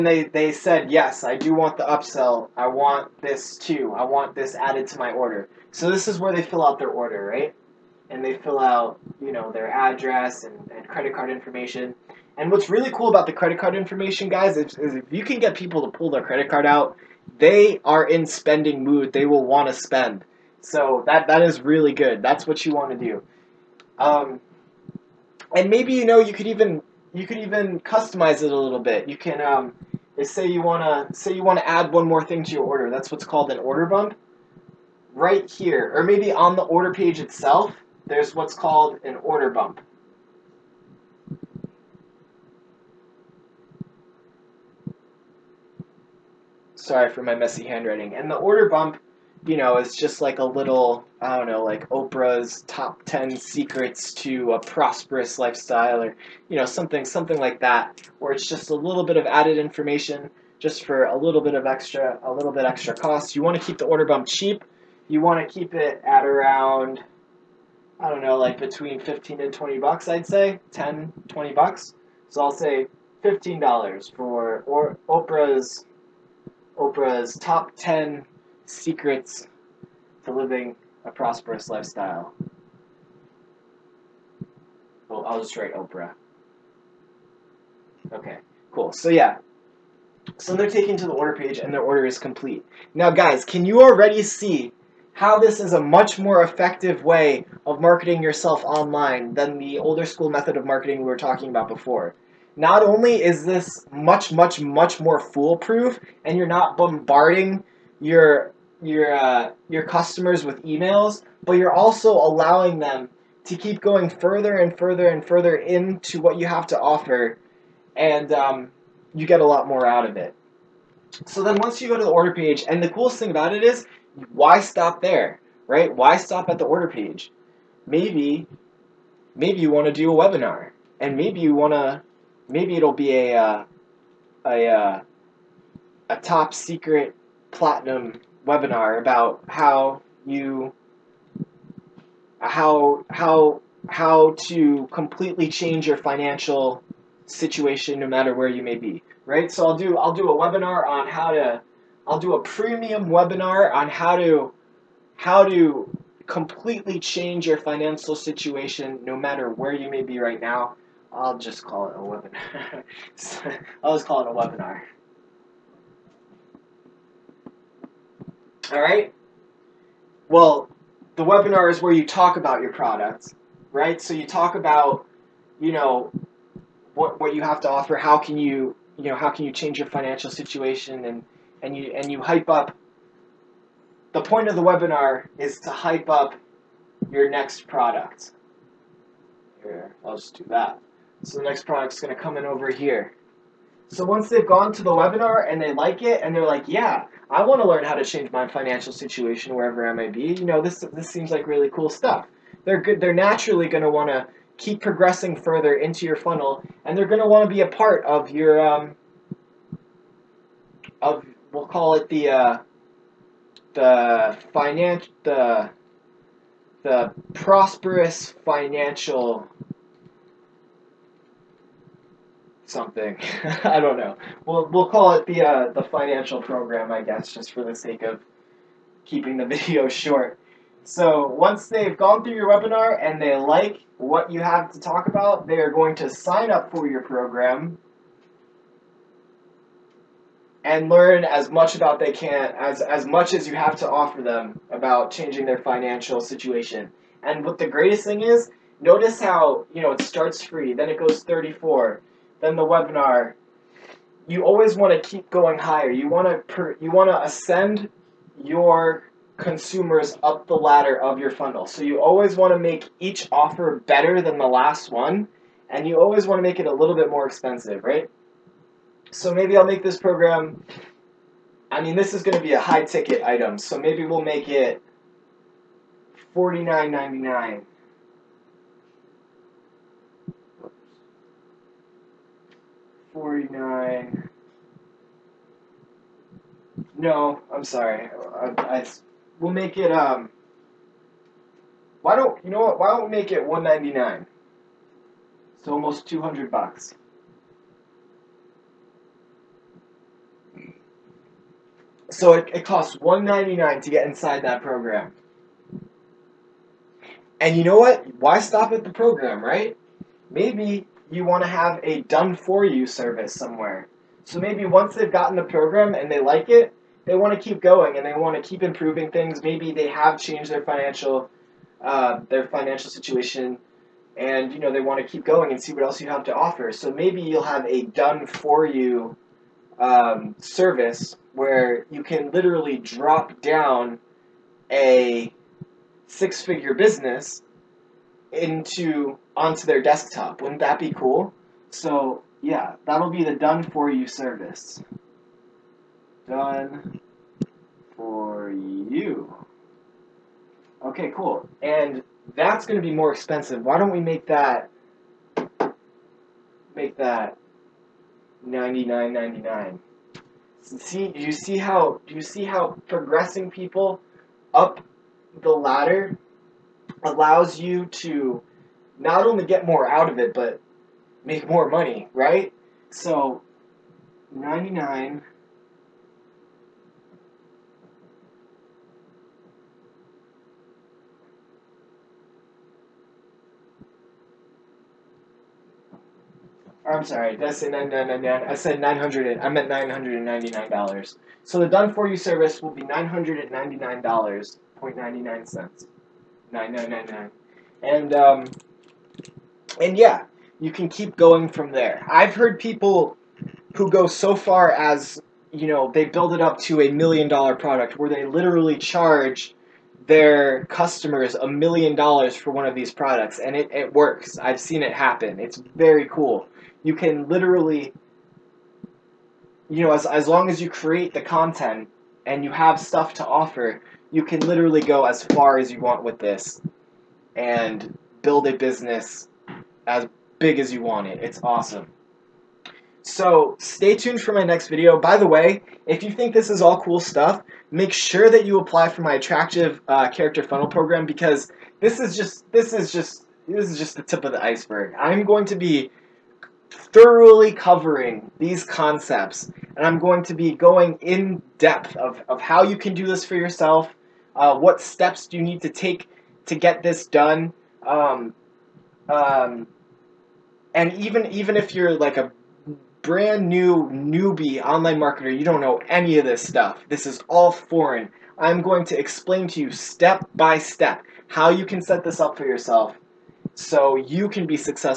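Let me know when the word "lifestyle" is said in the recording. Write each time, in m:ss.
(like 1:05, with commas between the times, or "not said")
0:55, 1:21.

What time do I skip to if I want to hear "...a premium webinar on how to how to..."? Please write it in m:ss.
2:32.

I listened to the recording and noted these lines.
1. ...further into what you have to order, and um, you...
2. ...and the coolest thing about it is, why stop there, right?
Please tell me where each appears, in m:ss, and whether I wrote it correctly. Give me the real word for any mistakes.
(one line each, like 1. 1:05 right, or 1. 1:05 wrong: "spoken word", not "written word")
1. 1:55 wrong: "offer", not "order"
2. 2:02 right.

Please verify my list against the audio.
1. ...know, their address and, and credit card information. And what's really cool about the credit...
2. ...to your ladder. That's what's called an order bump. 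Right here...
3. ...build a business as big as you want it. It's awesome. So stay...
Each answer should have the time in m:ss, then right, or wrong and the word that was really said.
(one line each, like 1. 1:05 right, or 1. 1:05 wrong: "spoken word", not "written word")
1. 0:09 right
2. 0:32 wrong: "order", not "ladder"
3. 7:08 right.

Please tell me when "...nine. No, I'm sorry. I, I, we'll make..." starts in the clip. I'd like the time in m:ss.
4:43.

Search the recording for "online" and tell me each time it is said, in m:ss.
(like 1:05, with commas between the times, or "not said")
1:38, 7:44.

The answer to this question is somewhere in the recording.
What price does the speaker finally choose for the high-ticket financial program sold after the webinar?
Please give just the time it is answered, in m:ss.
4:52.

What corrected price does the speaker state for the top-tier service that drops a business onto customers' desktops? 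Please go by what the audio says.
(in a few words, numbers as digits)
$999.99.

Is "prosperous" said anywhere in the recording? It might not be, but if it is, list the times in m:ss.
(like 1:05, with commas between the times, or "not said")
0:54, 1:21, 3:37.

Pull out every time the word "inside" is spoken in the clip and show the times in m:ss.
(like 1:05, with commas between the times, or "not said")
5:04.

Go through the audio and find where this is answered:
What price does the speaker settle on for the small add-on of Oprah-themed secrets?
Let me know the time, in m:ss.
1:12.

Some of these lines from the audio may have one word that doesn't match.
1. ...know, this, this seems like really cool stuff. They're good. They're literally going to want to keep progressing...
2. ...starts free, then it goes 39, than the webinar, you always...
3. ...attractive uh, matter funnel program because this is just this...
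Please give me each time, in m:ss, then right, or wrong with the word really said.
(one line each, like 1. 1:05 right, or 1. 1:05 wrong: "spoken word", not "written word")
1. 3:20 wrong: "naturally", not "literally"
2. 4:10 wrong: "34", not "39"
3. 7:19 wrong: "character", not "matter".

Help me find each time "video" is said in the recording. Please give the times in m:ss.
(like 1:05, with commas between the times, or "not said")
3:49, 7:14.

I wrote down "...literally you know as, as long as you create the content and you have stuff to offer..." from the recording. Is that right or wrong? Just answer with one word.
right.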